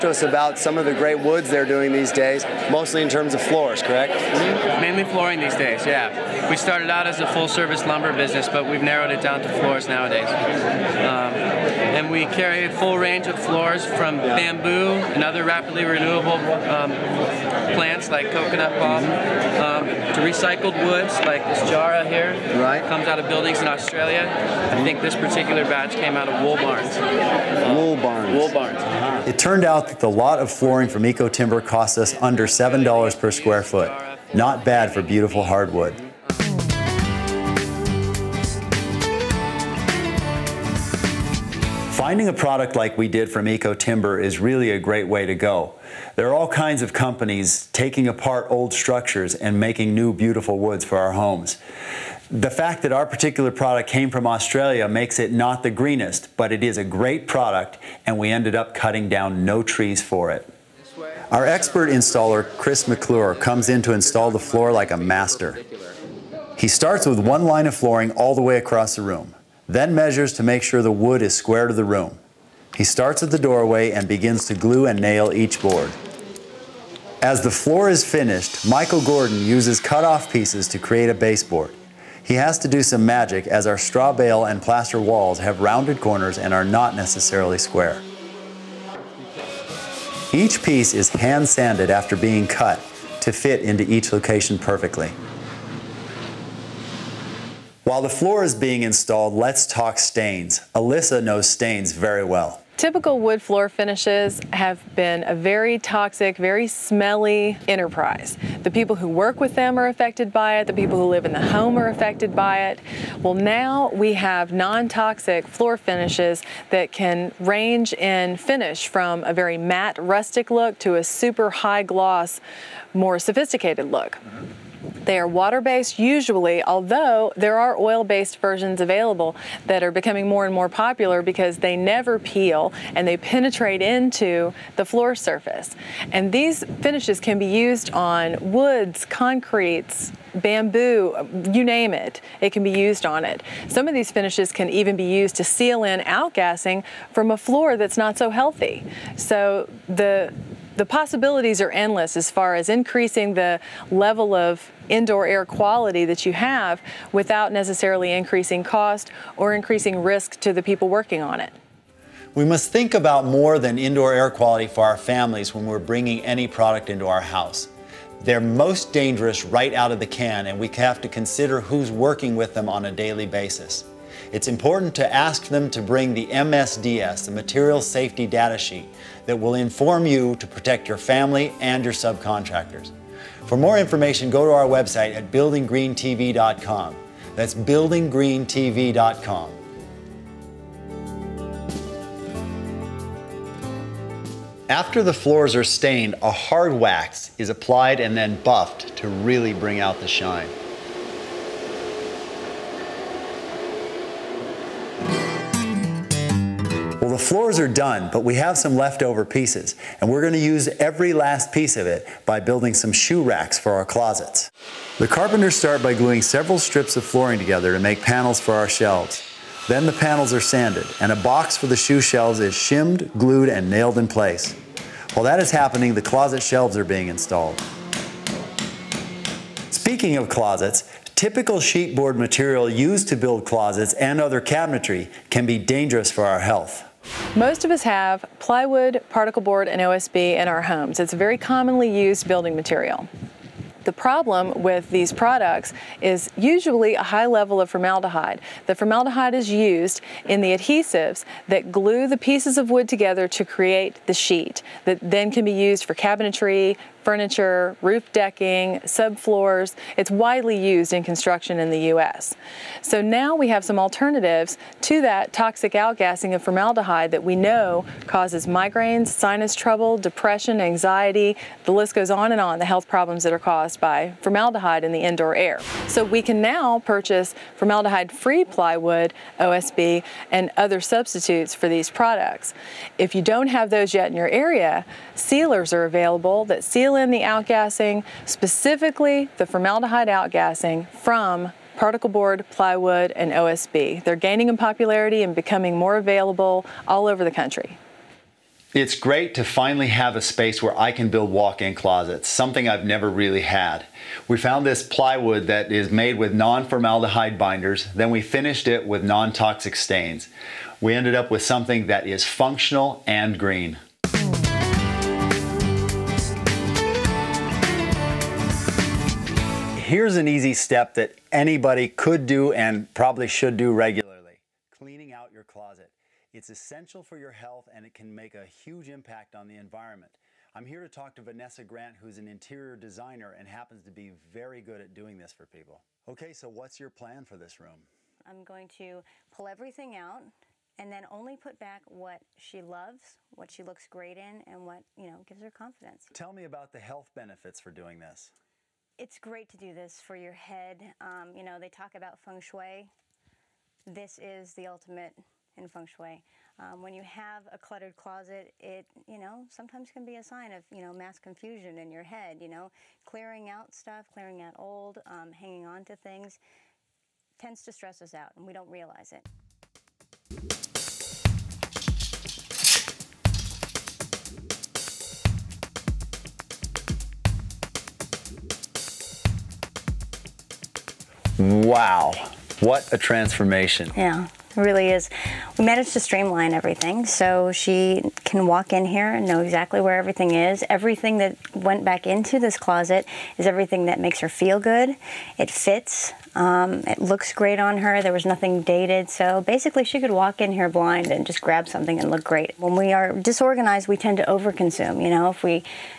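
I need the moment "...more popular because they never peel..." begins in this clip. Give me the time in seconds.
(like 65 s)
130 s.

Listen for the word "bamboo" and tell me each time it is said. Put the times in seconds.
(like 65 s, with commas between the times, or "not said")
14 s, 140 s.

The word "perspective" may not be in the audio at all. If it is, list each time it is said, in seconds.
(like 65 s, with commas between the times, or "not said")
not said.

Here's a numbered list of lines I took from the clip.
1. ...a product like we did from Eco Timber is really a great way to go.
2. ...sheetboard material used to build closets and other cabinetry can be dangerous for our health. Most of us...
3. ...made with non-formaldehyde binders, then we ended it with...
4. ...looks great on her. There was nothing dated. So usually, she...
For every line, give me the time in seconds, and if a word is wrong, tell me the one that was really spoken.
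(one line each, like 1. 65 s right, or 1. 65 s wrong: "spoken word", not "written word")
1. 42 s right
2. 231 s right
3. 305 s wrong: "finished", not "ended"
4. 396 s wrong: "basically", not "usually".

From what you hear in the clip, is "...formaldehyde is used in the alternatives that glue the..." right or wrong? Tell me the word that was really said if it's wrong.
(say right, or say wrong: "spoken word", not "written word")
wrong: "adhesives", not "alternatives".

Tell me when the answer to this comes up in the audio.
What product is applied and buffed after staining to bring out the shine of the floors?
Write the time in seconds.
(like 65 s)
196 s.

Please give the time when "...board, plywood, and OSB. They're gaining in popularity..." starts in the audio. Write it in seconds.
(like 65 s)
292 s.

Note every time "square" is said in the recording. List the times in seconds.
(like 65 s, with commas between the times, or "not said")
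33 s, 71 s, 87 s.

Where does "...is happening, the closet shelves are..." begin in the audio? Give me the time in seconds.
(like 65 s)
225 s.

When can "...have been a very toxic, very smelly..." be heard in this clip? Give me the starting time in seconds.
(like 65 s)
104 s.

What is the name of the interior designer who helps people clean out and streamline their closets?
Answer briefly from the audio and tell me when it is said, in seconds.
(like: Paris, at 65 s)
Vanessa Grant, at 331 s.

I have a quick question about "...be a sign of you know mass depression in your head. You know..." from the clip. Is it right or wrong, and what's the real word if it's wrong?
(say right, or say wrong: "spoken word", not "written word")
wrong: "confusion", not "depression".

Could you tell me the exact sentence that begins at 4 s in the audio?
Mainly flooring these days, yeah we started out as a full service lumber business, but we've narrowed it down to floors nowadays.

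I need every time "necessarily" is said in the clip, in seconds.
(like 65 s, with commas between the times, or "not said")
86 s, 157 s.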